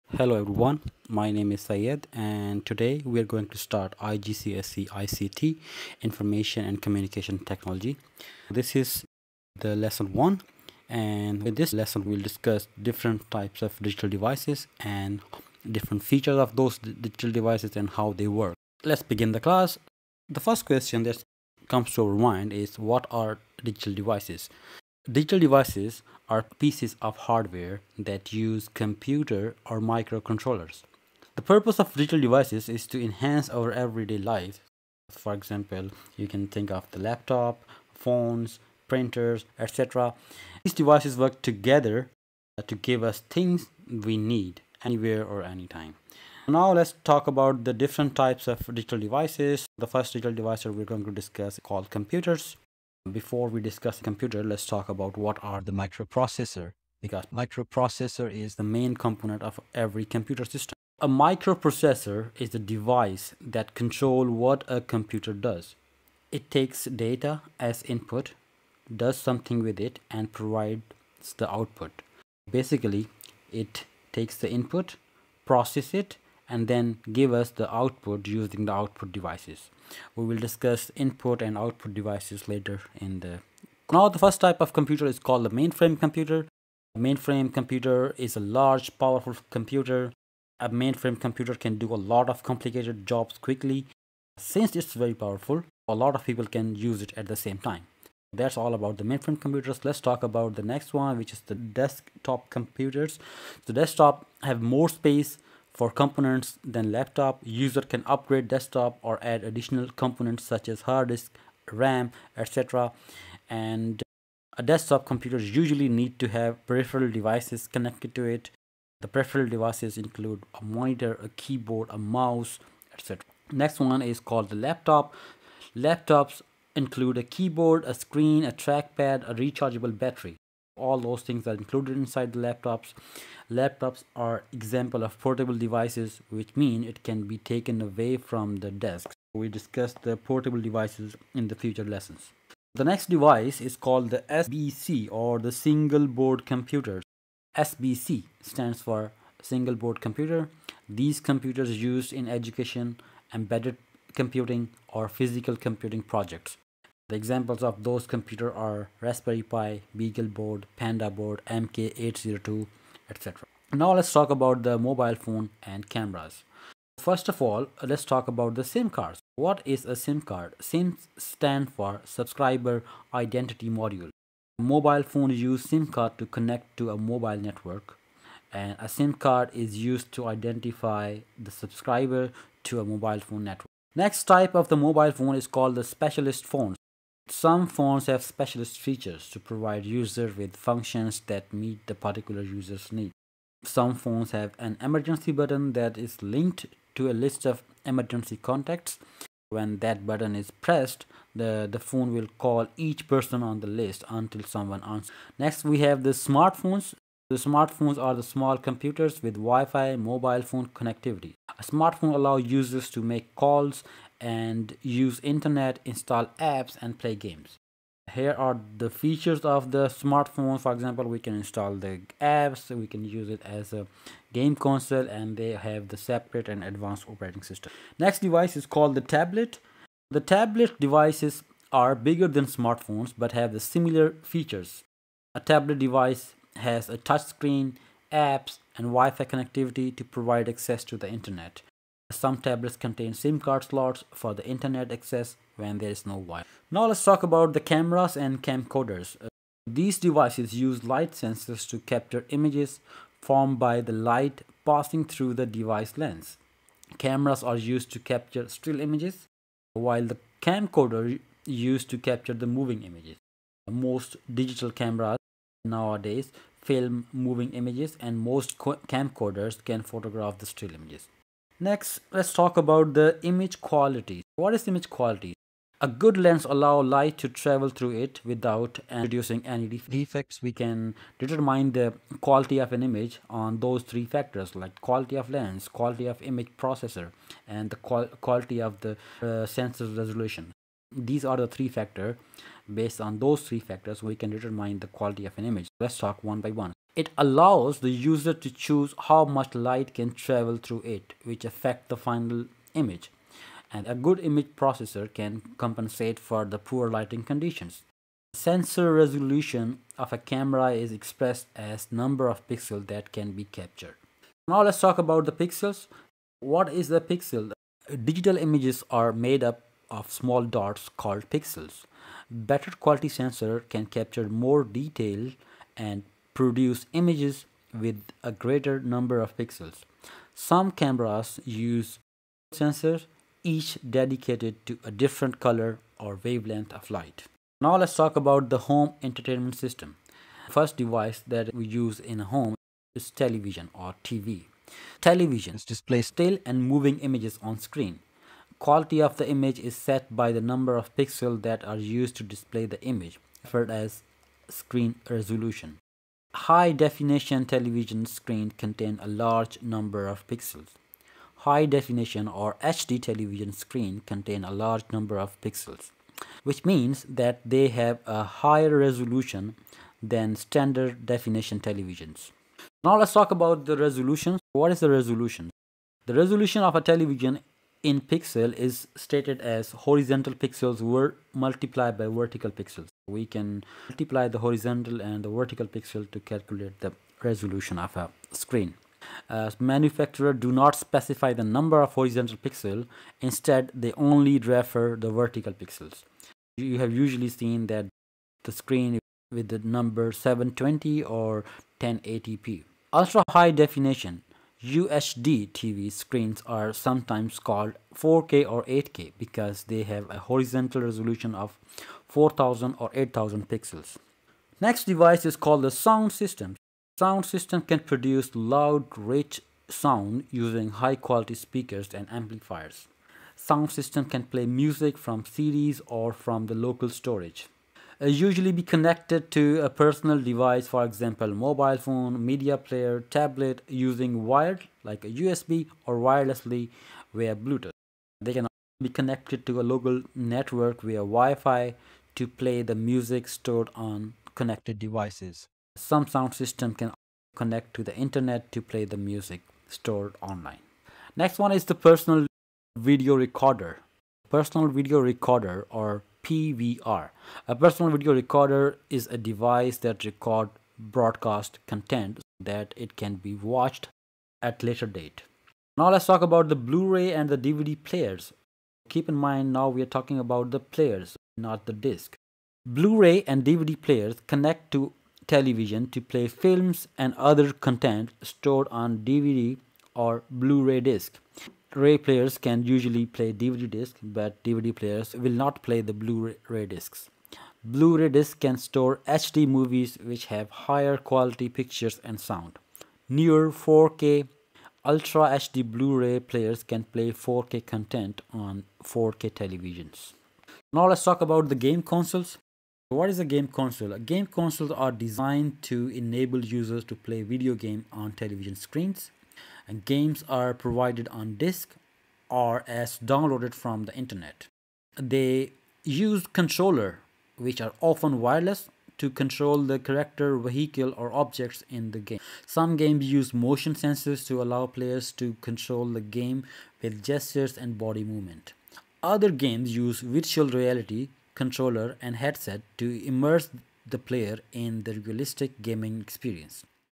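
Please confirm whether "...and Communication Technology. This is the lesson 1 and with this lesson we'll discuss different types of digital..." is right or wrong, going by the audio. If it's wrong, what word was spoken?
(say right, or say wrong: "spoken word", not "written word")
right.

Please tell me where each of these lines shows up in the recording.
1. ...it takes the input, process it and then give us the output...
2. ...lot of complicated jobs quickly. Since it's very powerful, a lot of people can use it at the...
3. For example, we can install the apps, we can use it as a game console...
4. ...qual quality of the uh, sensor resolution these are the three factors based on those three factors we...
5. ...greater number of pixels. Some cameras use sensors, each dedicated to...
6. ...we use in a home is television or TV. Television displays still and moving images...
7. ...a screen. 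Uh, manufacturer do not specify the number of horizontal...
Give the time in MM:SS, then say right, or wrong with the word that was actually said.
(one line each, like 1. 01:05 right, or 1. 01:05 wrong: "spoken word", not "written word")
1. 01:13 right
2. 01:32 right
3. 03:40 right
4. 04:47 right
5. 05:28 right
6. 05:41 right
7. 06:27 right.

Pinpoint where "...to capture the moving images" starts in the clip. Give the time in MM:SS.
04:21.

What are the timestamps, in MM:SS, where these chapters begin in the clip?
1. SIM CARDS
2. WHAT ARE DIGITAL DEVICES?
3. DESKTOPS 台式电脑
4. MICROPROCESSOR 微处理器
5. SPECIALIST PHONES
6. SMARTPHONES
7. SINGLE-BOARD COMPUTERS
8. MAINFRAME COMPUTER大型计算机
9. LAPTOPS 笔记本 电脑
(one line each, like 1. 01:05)
1. 02:47
2. 00:20
3. 01:41
4. 00:59
5. 03:04
6. 03:25
7. 02:25
8. 01:24
9. 02:04.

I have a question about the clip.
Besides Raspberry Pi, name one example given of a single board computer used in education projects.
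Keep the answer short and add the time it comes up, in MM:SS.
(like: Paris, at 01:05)
BeagleBoard, at 02:39.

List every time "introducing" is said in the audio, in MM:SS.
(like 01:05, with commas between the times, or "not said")
04:38.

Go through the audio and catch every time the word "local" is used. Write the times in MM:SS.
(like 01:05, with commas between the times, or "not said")
07:06, 07:19.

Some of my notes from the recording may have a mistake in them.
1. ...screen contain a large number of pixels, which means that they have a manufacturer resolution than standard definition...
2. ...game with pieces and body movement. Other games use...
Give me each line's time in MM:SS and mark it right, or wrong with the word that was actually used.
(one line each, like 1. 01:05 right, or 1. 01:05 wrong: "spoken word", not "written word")
1. 06:03 wrong: "higher", not "manufacturer"
2. 08:46 wrong: "gestures", not "pieces".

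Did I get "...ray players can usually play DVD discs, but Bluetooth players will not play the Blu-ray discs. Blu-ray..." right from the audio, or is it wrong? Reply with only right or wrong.
wrong.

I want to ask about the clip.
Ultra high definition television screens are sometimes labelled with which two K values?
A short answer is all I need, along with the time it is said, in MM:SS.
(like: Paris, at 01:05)
4K or 8K, at 06:47.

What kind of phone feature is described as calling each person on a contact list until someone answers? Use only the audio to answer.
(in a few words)
emergency button.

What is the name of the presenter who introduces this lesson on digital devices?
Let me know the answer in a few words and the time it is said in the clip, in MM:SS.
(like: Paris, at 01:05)
Syed, at 00:01.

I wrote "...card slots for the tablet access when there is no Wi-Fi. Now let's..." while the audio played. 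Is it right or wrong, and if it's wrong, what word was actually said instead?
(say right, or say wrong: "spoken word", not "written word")
wrong: "internet", not "tablet".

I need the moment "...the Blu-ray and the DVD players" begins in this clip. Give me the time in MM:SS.
07:46.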